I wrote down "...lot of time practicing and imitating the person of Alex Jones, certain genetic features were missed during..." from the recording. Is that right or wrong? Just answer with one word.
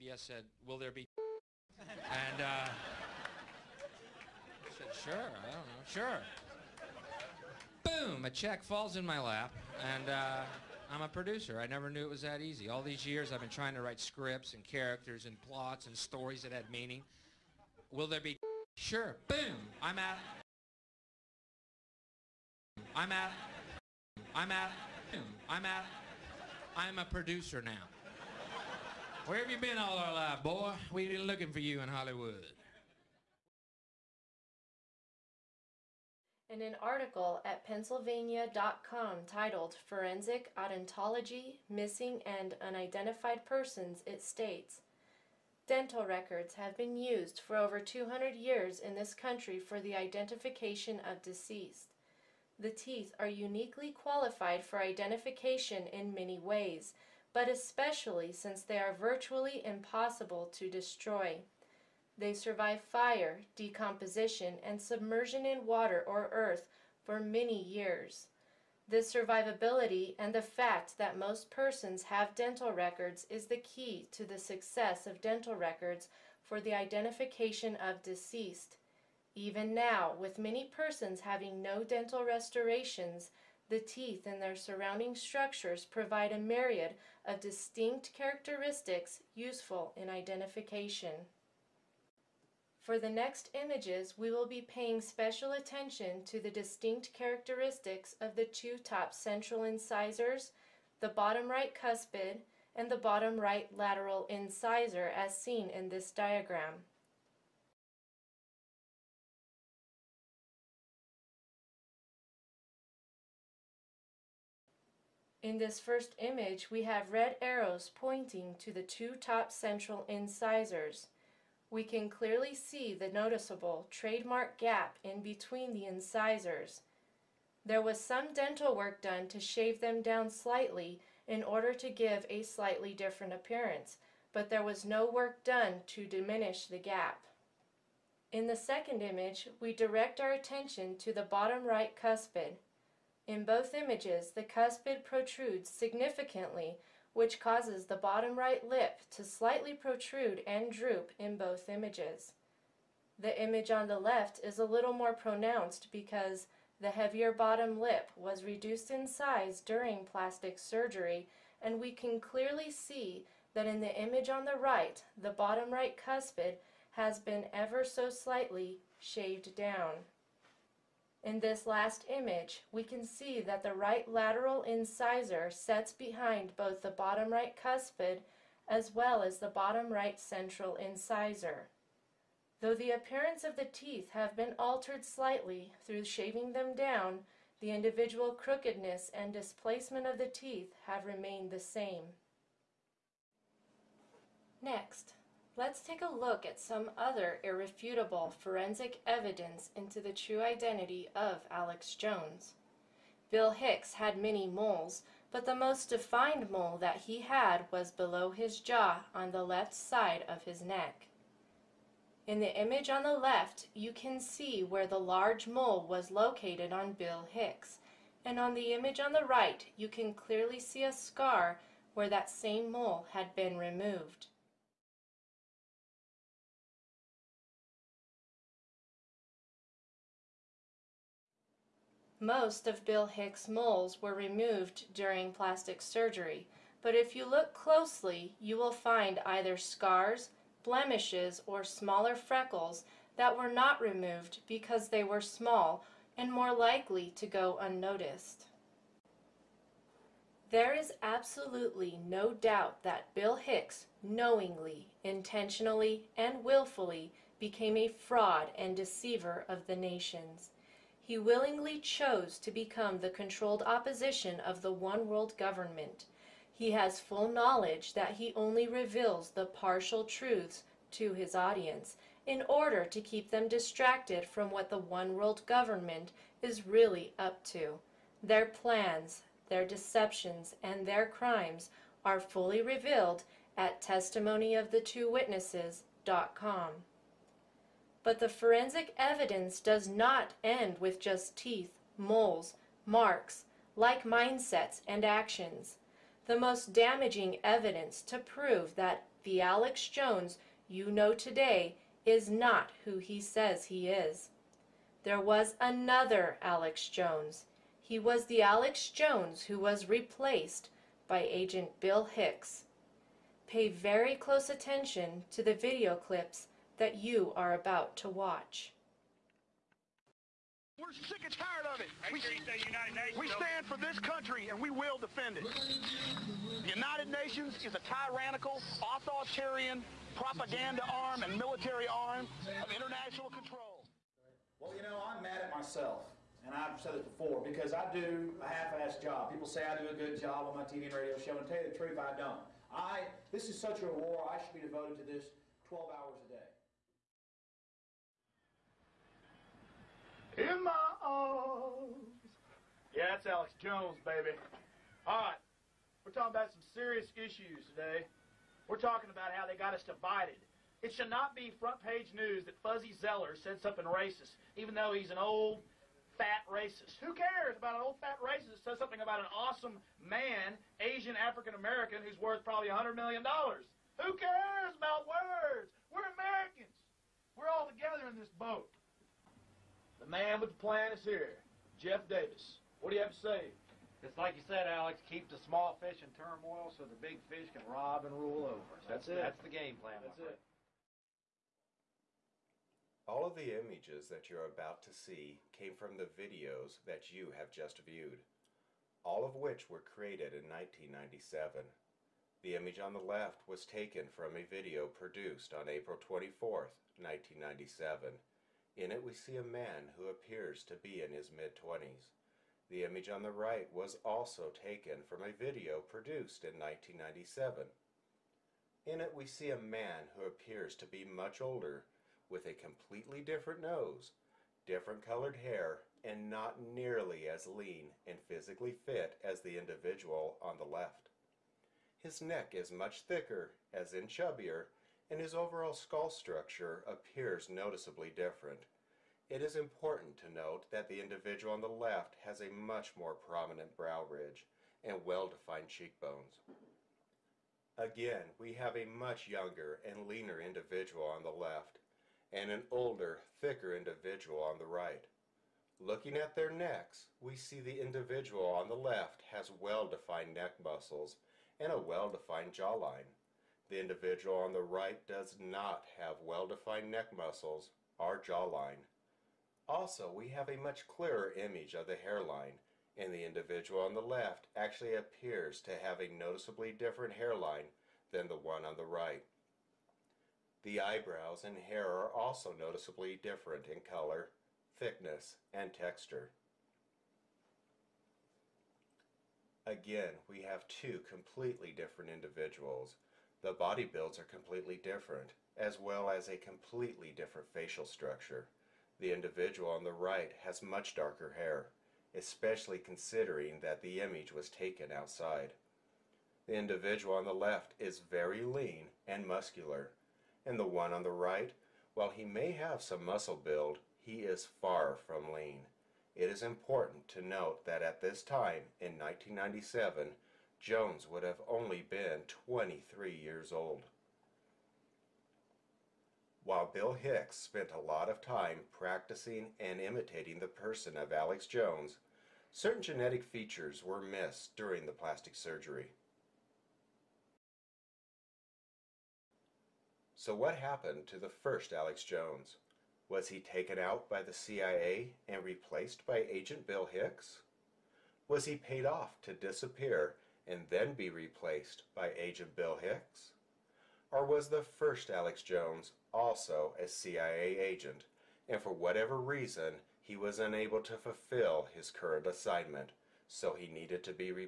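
right.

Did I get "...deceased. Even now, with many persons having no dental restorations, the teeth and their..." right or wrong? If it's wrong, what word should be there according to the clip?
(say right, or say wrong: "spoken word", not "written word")
right.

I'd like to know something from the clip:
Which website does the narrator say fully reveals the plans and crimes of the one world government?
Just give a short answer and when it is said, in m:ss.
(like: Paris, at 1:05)
testimonyoftheTwoWitnesses.com, at 4:43.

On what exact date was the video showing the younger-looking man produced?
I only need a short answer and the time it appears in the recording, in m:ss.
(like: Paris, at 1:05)
April 24, 1997, at 6:45.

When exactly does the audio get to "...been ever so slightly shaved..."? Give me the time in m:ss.
2:47.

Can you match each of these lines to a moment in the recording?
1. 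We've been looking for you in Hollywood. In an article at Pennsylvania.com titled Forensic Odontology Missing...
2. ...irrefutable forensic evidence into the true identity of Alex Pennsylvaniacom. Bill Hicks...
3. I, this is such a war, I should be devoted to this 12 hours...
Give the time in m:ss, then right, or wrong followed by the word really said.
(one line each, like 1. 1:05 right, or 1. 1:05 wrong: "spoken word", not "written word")
1. 0:30 right
2. 3:17 wrong: "Jones", not "Pennsylvaniacom"
3. 5:42 right.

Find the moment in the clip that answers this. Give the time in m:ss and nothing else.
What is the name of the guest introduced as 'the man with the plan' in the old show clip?
6:21.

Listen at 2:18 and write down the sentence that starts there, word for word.
In the second image, we direct our attention to the bottom right cuspid.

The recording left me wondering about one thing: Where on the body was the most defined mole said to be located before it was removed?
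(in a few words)
left side of his neck.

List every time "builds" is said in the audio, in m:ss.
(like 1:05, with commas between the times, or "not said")
8:13, 8:33.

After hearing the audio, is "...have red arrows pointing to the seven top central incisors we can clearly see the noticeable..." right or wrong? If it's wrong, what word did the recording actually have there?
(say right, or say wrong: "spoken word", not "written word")
wrong: "two", not "seven".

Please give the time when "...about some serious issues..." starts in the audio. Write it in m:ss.
5:56.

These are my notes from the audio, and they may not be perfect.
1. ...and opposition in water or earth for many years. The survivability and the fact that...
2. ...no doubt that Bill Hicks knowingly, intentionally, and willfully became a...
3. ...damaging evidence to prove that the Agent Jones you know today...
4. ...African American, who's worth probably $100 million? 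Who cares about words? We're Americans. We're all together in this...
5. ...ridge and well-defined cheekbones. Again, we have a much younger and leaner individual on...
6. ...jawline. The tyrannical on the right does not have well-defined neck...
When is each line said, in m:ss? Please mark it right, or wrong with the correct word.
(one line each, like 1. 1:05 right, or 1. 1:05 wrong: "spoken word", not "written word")
1. 1:04 wrong: "submersion", not "opposition"
2. 4:12 right
3. 4:56 wrong: "Alex", not "Agent"
4. 6:11 right
5. 7:24 right
6. 7:42 wrong: "individual", not "tyrannical".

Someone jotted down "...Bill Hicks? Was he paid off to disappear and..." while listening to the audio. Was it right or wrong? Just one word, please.
right.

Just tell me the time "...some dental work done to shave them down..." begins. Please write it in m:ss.
2:07.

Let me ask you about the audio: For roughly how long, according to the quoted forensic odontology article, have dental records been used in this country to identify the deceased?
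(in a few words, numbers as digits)
200 years.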